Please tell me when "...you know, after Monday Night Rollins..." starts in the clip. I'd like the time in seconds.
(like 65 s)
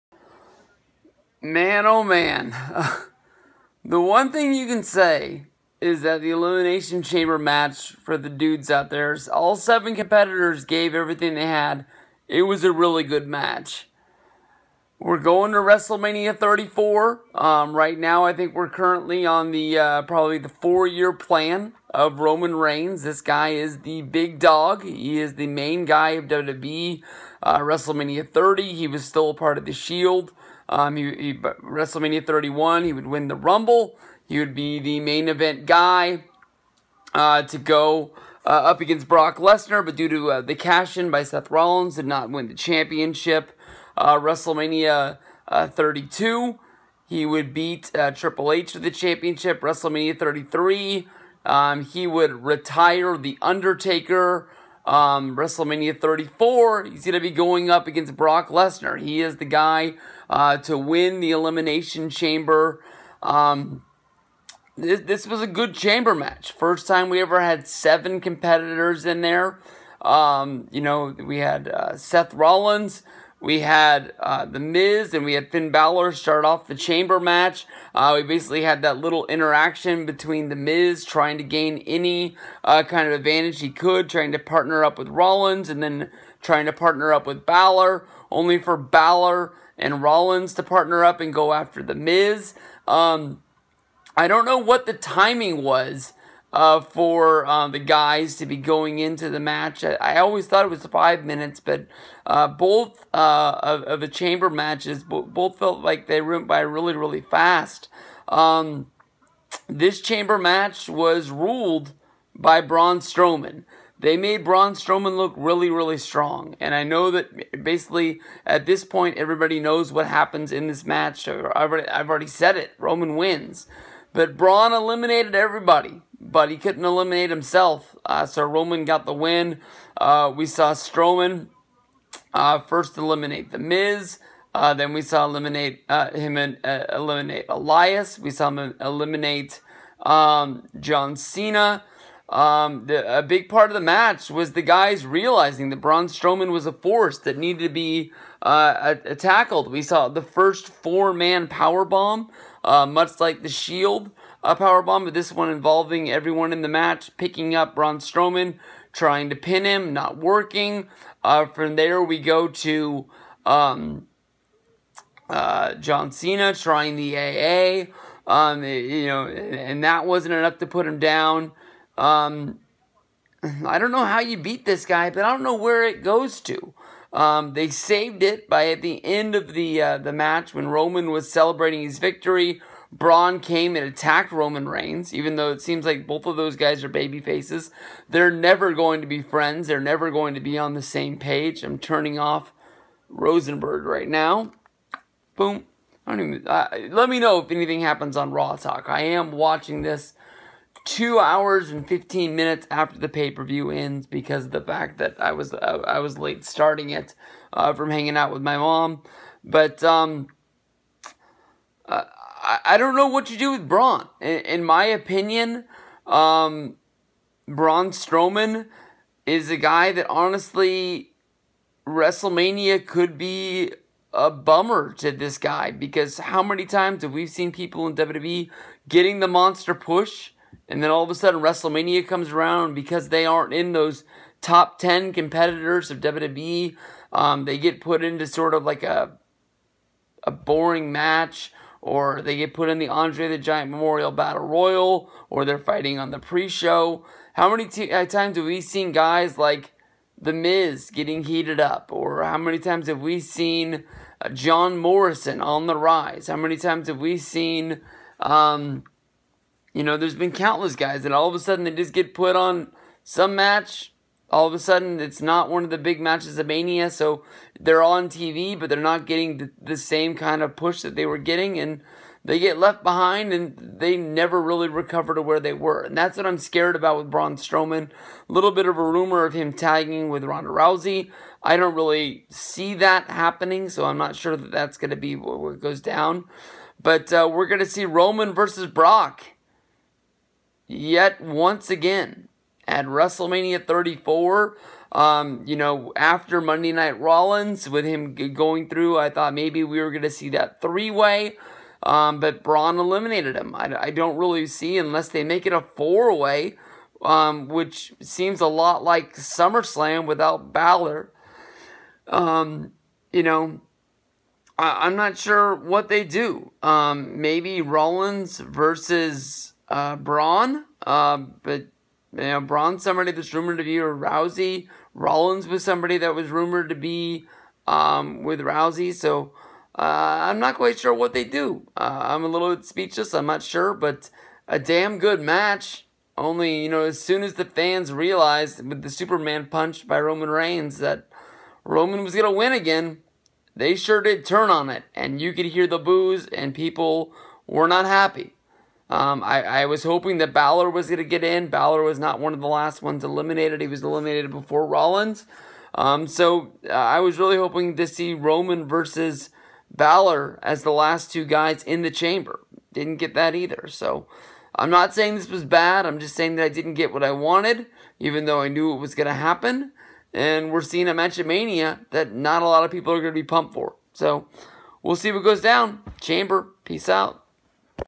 295 s.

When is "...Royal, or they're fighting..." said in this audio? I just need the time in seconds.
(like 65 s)
244 s.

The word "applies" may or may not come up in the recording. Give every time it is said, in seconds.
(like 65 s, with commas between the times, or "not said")
not said.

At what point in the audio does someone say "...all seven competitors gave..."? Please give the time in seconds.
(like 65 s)
9 s.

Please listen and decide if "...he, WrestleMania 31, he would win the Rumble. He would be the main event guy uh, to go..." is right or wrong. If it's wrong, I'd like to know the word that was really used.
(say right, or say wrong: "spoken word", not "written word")
right.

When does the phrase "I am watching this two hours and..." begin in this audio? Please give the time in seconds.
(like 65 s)
198 s.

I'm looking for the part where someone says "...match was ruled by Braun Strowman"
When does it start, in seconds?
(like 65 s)
110 s.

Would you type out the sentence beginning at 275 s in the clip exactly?
And that's what I'm scared about with Braun Strowman.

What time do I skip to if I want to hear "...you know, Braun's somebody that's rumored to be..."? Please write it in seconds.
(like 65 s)
322 s.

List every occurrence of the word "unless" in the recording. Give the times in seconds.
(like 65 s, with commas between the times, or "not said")
304 s.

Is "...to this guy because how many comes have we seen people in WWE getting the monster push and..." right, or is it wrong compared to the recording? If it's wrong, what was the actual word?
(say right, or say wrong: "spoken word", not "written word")
wrong: "times", not "comes".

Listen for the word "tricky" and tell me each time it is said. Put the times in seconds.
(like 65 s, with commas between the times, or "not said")
not said.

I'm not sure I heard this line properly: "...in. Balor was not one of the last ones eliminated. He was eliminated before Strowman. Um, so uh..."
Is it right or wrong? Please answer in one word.
wrong.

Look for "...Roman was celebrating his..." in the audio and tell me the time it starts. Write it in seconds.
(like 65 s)
180 s.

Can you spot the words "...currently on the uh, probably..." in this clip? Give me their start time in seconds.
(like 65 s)
18 s.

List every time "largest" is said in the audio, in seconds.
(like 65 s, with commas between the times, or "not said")
not said.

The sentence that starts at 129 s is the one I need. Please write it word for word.
Uh, we saw Strowman uh, first eliminate The Miz.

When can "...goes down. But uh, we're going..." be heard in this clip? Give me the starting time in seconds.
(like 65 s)
285 s.